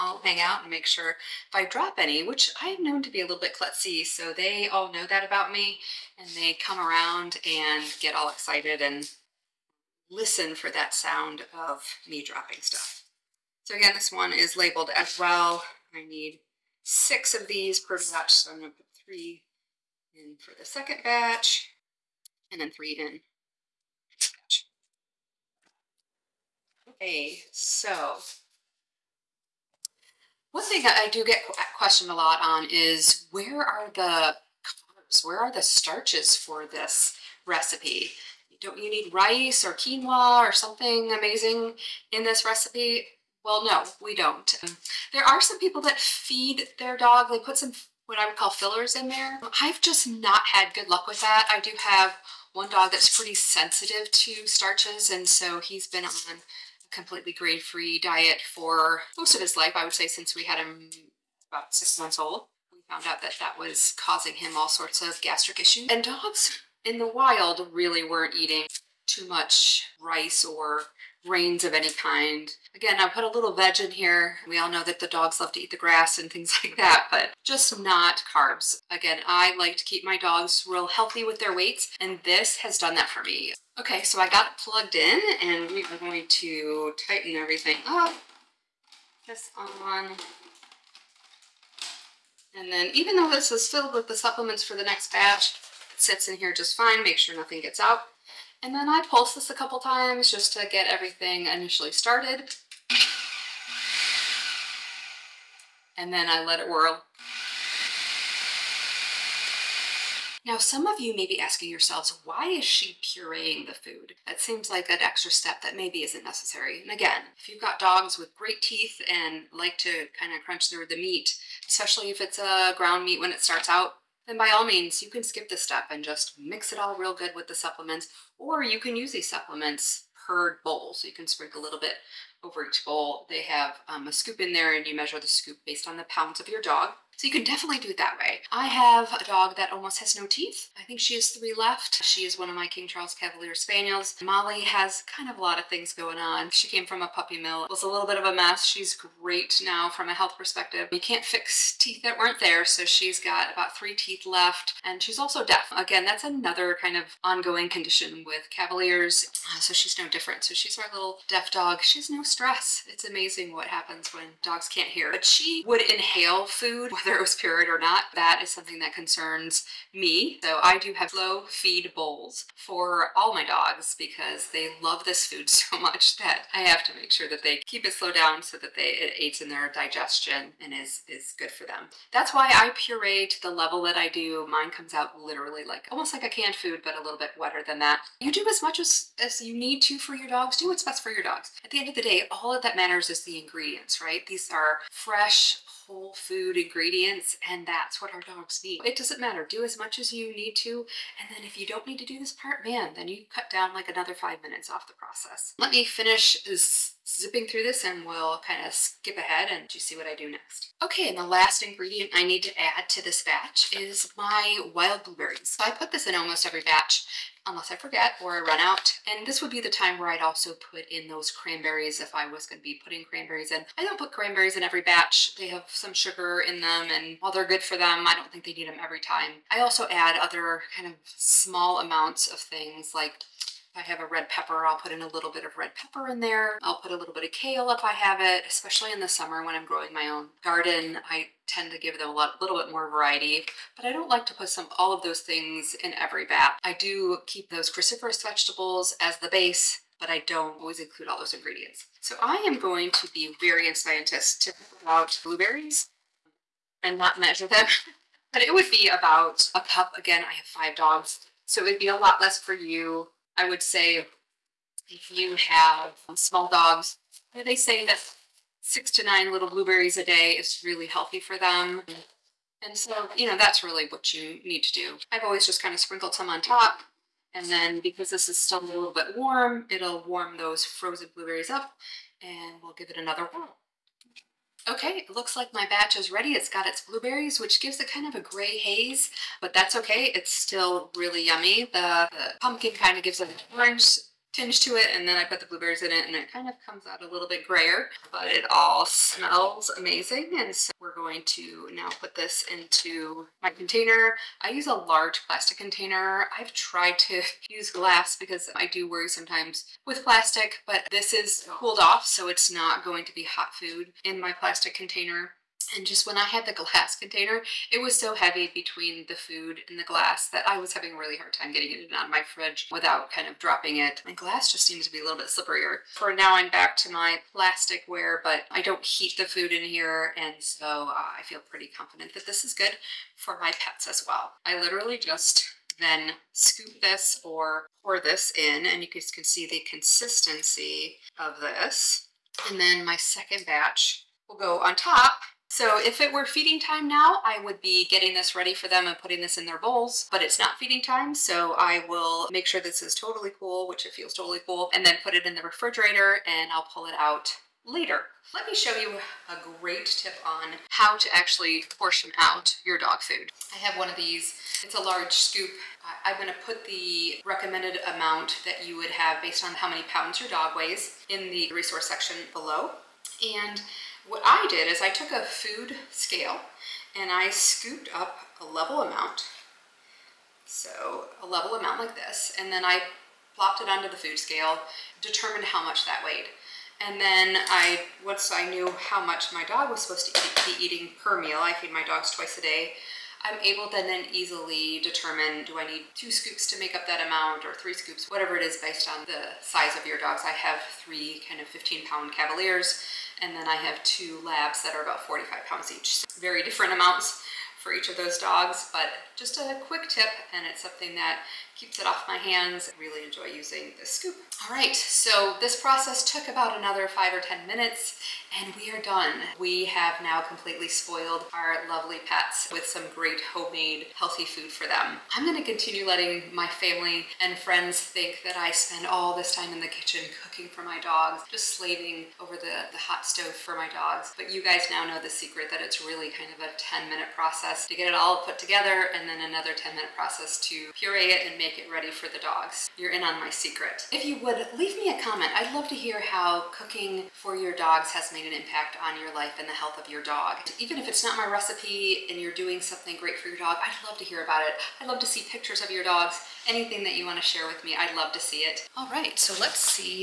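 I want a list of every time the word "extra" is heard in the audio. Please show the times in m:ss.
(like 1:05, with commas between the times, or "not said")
1:54.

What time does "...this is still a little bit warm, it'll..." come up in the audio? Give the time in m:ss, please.
4:38.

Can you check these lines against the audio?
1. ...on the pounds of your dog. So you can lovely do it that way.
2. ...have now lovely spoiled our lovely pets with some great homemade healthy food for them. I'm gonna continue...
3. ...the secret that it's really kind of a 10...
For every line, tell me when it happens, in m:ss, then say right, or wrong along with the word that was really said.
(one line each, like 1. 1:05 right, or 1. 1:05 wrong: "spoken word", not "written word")
1. 2:15 wrong: "definitely", not "lovely"
2. 6:59 wrong: "completely", not "lovely"
3. 7:15 right.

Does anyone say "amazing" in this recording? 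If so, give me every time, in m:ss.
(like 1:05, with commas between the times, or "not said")
0:41, 2:43, 4:59.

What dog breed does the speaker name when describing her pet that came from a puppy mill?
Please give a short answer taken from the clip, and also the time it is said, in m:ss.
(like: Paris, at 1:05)
King Charles Cavalier Spaniels, at 2:22.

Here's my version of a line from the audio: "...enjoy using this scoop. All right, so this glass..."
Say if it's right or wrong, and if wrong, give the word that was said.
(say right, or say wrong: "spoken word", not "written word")
wrong: "process", not "glass".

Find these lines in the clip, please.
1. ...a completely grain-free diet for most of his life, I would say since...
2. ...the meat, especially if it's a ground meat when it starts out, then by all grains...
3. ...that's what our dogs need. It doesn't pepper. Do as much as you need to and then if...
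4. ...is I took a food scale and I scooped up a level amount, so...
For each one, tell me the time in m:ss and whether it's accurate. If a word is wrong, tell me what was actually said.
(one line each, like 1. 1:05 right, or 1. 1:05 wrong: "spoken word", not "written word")
1. 0:56 right
2. 2:00 wrong: "means", not "grains"
3. 3:17 wrong: "matter", not "pepper"
4. 6:14 right.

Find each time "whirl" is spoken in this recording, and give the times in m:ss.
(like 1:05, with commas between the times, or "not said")
1:46, 4:43.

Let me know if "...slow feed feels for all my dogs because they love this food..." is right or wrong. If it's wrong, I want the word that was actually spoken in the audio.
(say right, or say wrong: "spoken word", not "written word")
wrong: "bowls", not "feels".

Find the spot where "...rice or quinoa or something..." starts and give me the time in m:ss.
0:39.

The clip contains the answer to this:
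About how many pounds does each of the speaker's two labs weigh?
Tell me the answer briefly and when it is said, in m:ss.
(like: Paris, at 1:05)
45 pounds, at 6:45.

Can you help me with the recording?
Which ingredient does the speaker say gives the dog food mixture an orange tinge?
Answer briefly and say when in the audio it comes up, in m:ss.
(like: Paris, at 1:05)
Pumpkin, at 4:52.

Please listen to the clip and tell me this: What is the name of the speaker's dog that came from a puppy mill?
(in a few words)
Molly.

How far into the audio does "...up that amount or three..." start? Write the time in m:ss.
6:36.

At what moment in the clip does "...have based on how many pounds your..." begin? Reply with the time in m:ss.
6:08.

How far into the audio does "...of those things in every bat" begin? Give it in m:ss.
4:04.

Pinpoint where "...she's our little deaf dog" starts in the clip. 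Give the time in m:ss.
2:40.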